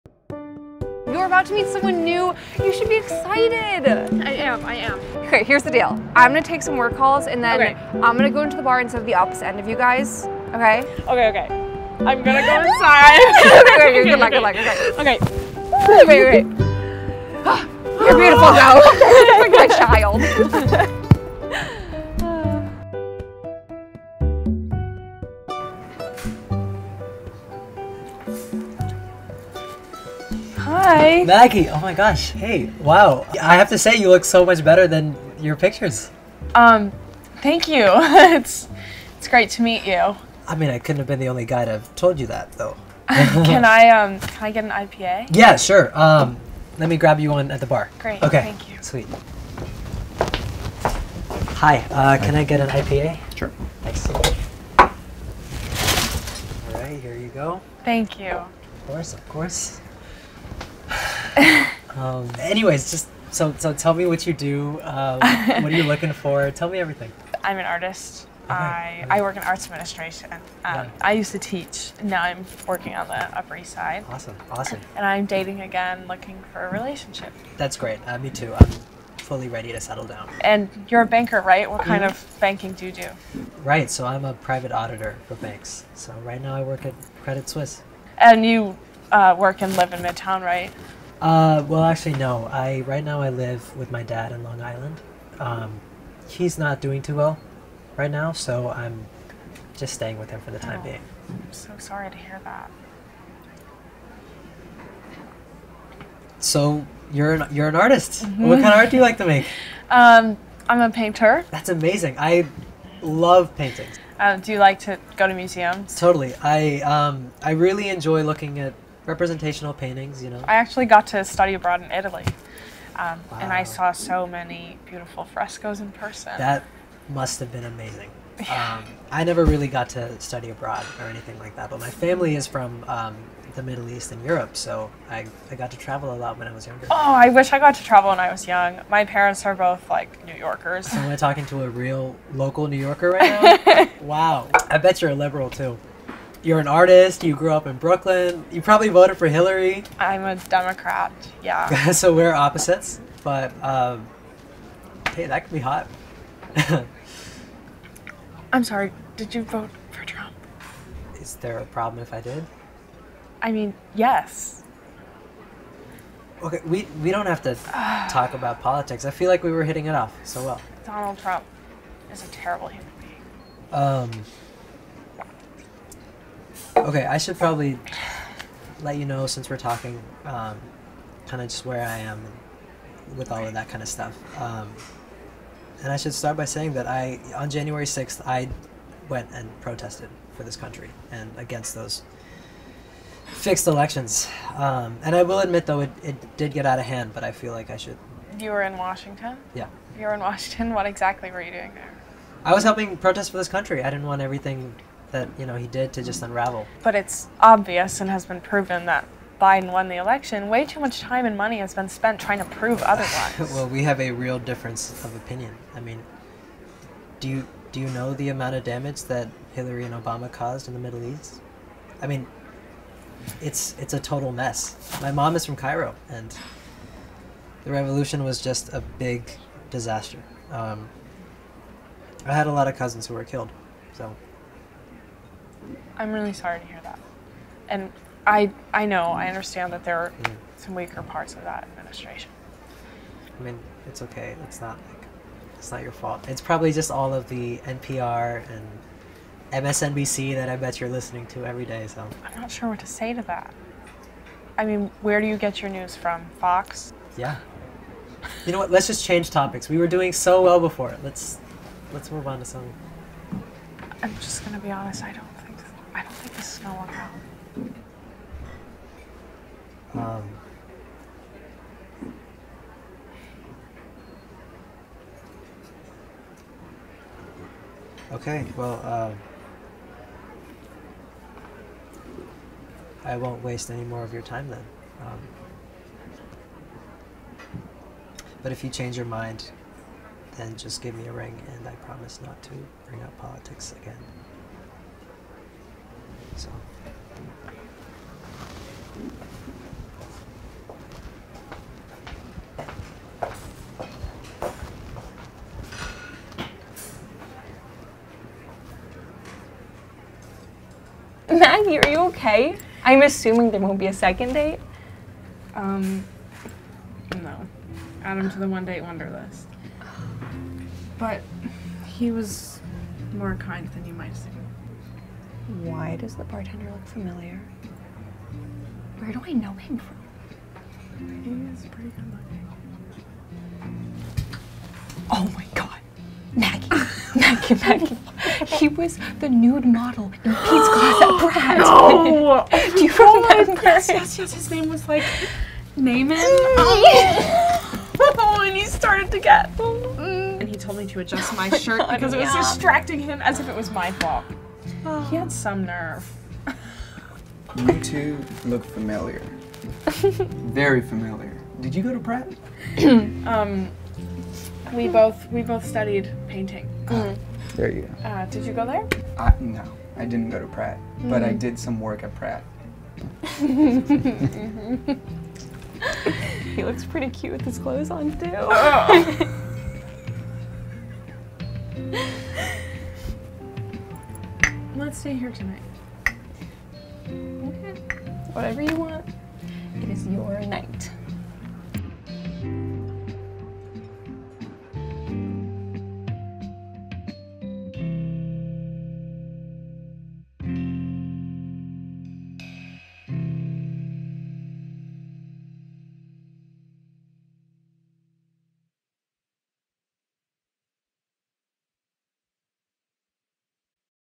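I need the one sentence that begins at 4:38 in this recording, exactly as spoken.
Okay, well, uh, I won't waste any more of your time then.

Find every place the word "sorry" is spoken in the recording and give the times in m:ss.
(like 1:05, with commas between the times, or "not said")
1:41, 2:38, 3:56.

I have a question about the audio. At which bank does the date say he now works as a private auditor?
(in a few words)
Credit Suisse.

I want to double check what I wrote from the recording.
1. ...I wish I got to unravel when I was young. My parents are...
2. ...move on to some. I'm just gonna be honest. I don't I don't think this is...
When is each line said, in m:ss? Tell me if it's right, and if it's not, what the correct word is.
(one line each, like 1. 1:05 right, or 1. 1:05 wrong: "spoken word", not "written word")
1. 2:17 wrong: "travel", not "unravel"
2. 4:22 right.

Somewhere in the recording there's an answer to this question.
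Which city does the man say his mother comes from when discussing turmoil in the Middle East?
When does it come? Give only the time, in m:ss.
3:45.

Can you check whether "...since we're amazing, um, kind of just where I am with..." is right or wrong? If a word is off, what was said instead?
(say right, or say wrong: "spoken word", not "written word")
wrong: "talking", not "amazing".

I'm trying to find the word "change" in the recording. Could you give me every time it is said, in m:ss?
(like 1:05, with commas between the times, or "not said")
4:19, 4:48.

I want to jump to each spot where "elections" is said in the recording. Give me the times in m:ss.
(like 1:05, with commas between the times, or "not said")
3:13, 3:29.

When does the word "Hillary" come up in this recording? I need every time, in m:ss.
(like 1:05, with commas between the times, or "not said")
2:29, 3:39.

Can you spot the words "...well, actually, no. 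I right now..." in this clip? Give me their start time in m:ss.
1:31.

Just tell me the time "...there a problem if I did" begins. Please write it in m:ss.
2:41.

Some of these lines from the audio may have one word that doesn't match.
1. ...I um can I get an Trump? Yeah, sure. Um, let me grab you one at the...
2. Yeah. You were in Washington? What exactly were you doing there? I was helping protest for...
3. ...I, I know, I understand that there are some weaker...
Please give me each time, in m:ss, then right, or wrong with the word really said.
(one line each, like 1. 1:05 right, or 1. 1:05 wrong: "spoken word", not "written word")
1. 0:43 wrong: "IPA", not "Trump"
2. 3:19 right
3. 3:58 right.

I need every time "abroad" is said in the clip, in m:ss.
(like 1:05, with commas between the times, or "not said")
2:01, 2:10.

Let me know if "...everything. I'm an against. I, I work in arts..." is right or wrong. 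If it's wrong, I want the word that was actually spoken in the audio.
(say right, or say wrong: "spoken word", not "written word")
wrong: "artist", not "against".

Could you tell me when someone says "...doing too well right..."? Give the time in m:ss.
1:36.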